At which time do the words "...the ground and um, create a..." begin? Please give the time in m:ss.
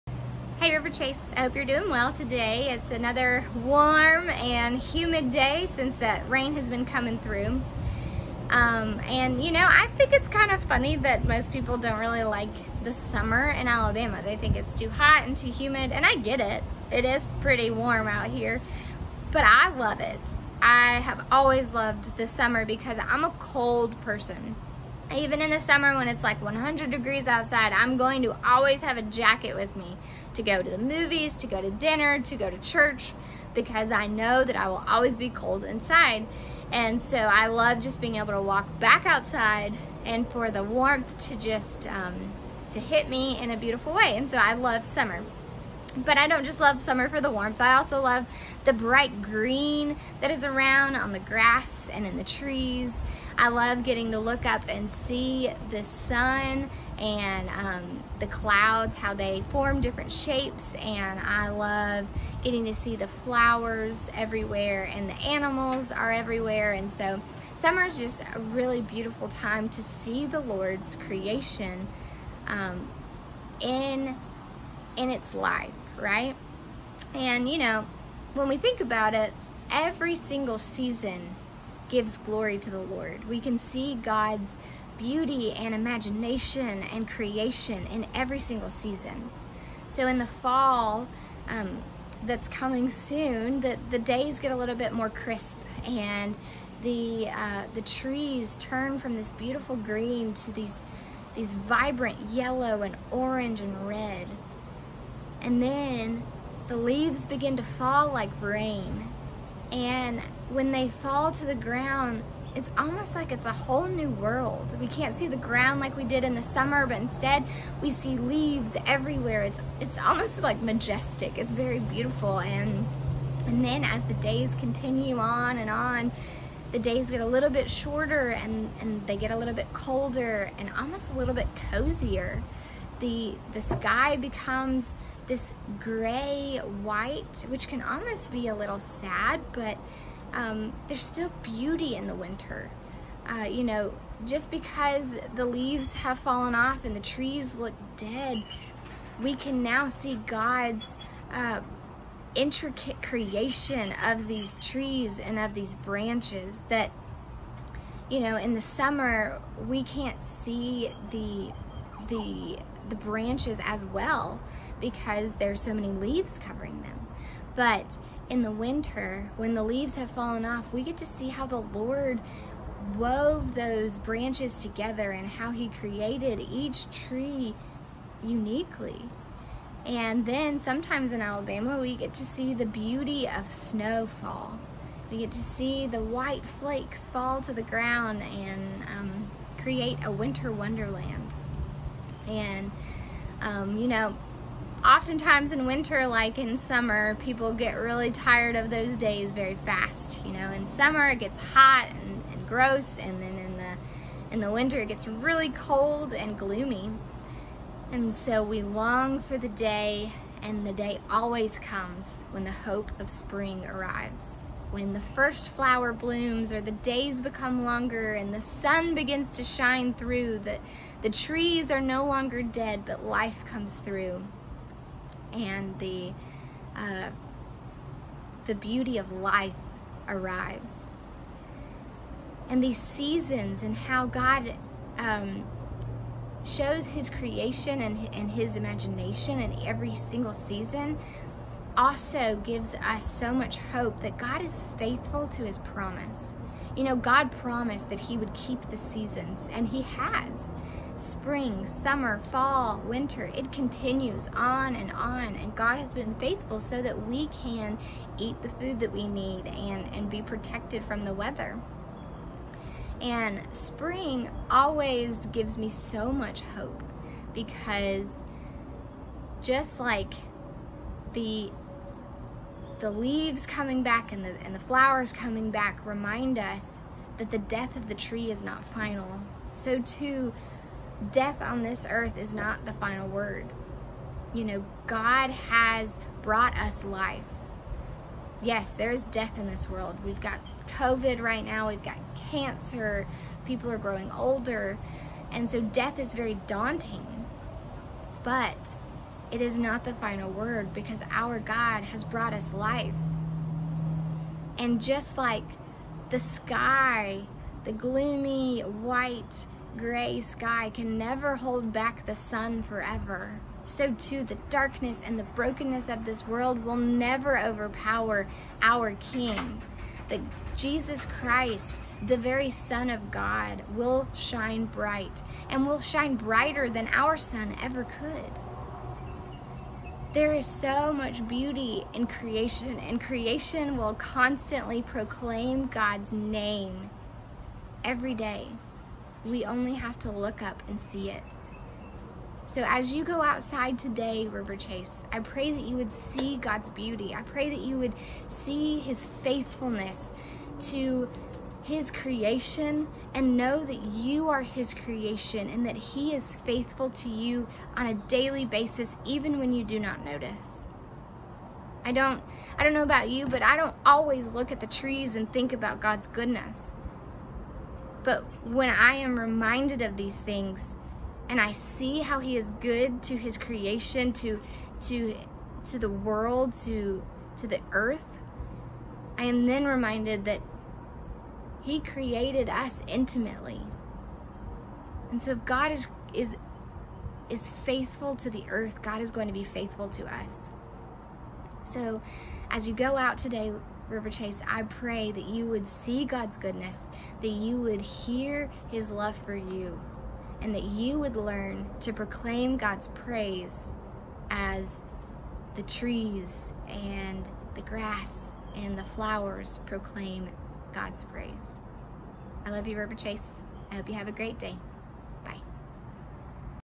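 3:07.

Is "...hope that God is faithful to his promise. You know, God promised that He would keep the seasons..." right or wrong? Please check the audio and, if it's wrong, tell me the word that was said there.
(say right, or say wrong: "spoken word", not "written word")
right.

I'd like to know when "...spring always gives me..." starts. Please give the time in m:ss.
4:23.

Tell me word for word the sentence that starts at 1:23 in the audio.
We can see God's beauty and imagination and creation in every single season.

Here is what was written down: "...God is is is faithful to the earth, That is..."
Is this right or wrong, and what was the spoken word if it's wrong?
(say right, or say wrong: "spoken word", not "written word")
wrong: "God", not "That".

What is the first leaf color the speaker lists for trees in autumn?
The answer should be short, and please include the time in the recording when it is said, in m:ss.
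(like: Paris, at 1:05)
yellow, at 1:42.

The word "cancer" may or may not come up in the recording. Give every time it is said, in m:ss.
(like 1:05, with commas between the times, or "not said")
4:52.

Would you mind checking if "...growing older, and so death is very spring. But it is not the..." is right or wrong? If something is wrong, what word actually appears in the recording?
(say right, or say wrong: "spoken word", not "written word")
wrong: "daunting", not "spring".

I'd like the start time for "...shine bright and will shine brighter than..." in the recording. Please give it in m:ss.
5:24.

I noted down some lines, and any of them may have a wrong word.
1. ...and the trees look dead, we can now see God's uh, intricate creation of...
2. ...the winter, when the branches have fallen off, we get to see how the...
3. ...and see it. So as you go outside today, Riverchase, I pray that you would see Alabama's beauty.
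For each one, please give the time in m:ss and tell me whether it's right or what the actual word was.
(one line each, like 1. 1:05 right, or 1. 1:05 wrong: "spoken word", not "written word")
1. 2:26 right
2. 2:48 wrong: "leaves", not "branches"
3. 5:40 wrong: "God", not "Alabama".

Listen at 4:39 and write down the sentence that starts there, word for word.
So too, death on this earth is not the final word.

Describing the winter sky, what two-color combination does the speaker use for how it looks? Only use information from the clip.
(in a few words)
gray white.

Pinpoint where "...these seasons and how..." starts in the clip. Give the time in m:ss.
3:52.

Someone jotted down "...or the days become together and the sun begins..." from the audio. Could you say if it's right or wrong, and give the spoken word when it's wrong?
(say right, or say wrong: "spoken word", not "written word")
wrong: "longer", not "together".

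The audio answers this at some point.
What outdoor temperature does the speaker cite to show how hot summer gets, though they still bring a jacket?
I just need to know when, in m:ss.
0:26.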